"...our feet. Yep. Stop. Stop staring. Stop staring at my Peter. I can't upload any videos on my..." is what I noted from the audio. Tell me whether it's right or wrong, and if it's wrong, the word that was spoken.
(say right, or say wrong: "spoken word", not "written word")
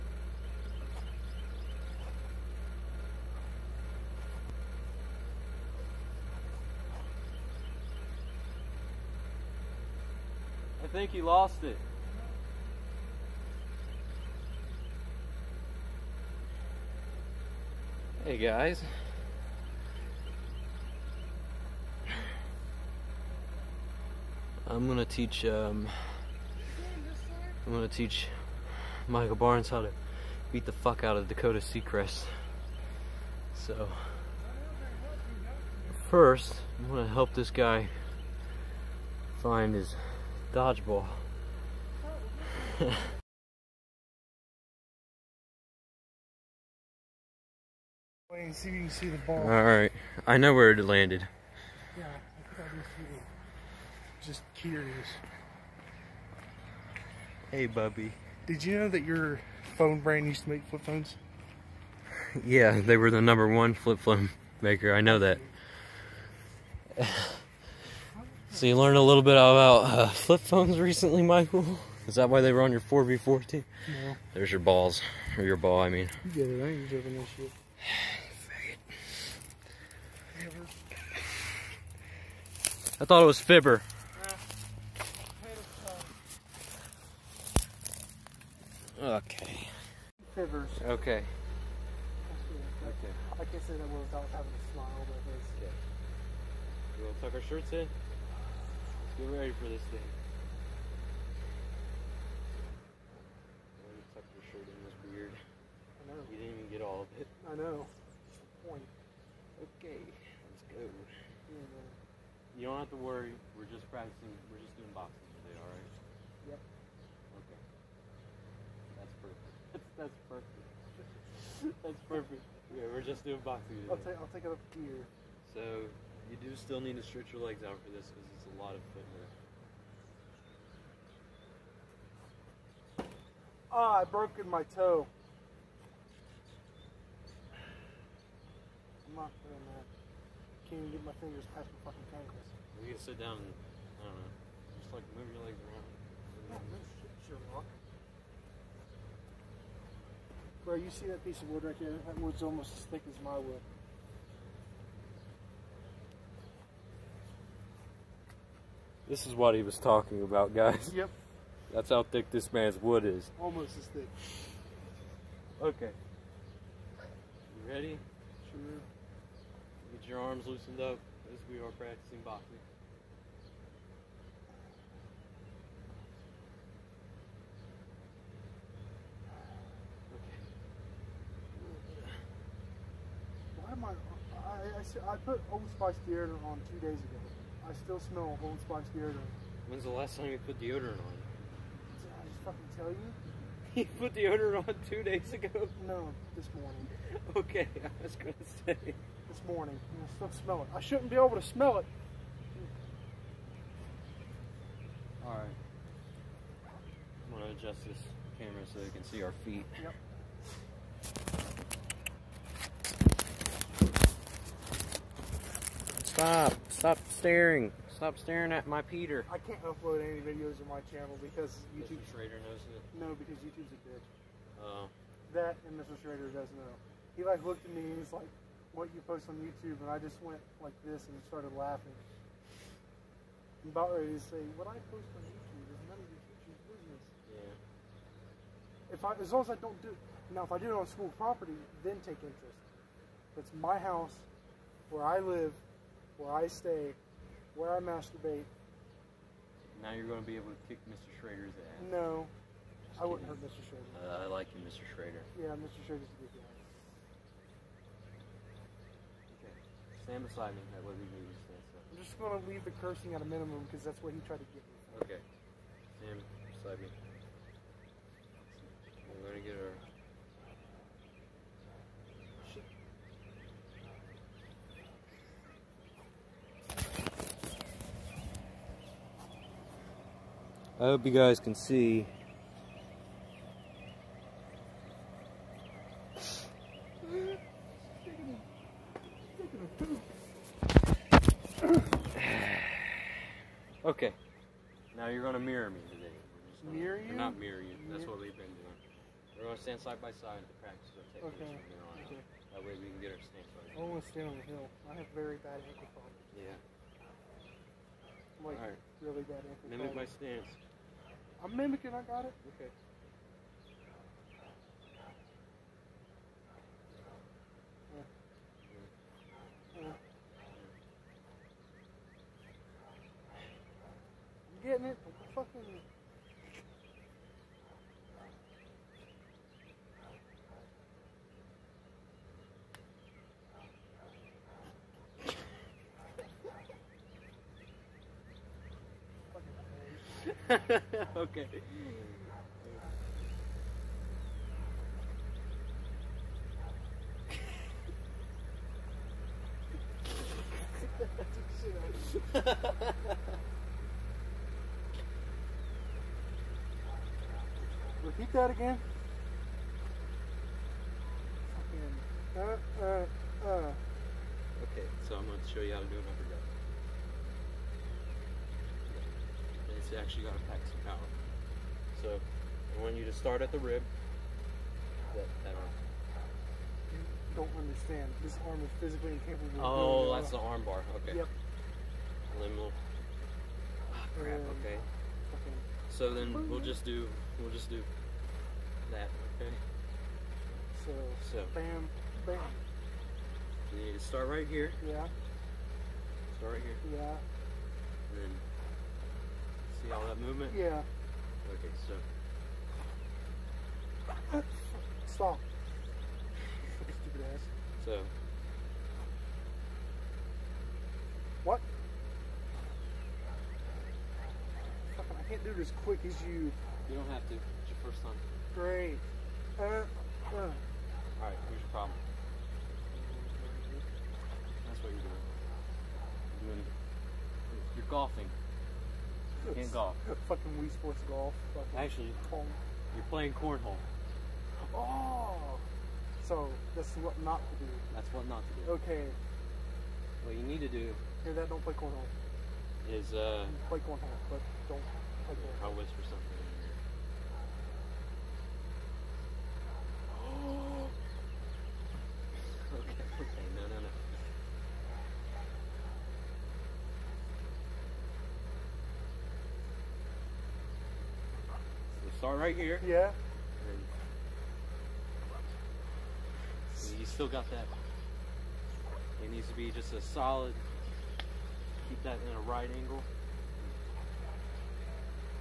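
right.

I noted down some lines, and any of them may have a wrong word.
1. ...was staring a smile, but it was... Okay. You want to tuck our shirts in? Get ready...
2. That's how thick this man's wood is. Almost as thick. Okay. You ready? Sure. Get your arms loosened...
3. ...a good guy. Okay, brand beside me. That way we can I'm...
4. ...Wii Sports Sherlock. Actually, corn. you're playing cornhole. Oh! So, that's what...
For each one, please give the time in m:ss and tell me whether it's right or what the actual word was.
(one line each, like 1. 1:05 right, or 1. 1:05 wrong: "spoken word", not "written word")
1. 1:34 wrong: "having", not "staring"
2. 2:41 right
3. 4:16 wrong: "stand", not "brand"
4. 7:10 wrong: "Golf", not "Sherlock".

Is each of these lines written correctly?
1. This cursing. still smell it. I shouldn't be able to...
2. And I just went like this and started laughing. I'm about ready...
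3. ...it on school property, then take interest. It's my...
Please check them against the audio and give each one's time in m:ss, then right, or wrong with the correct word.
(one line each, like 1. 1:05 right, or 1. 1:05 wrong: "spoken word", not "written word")
1. 3:18 wrong: "morning", not "cursing"
2. 3:49 right
3. 4:00 right.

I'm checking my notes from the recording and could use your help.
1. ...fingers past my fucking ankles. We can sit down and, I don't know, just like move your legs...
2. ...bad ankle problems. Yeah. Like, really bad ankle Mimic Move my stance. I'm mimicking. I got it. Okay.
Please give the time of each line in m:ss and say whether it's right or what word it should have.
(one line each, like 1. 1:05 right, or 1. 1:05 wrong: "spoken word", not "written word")
1. 2:21 right
2. 5:05 right.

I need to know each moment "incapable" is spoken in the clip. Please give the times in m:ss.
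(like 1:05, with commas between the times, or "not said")
6:19.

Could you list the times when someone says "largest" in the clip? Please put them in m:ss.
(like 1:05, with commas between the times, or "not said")
not said.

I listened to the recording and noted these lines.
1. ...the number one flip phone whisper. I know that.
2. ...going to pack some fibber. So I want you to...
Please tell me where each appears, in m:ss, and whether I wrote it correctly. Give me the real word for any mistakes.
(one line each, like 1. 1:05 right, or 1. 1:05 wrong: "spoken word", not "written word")
1. 1:03 wrong: "maker", not "whisper"
2. 6:10 wrong: "power", not "fibber".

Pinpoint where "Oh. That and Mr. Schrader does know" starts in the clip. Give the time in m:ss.
3:44.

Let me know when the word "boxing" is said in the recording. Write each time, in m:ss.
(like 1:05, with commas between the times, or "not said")
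1:54, 2:03, 2:52.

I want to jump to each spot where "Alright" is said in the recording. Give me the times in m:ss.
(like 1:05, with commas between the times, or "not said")
0:49, 3:25, 7:00.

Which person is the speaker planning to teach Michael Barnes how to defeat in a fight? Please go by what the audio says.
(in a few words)
Dakota Seacrest.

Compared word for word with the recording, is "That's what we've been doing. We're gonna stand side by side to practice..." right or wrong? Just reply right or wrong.
right.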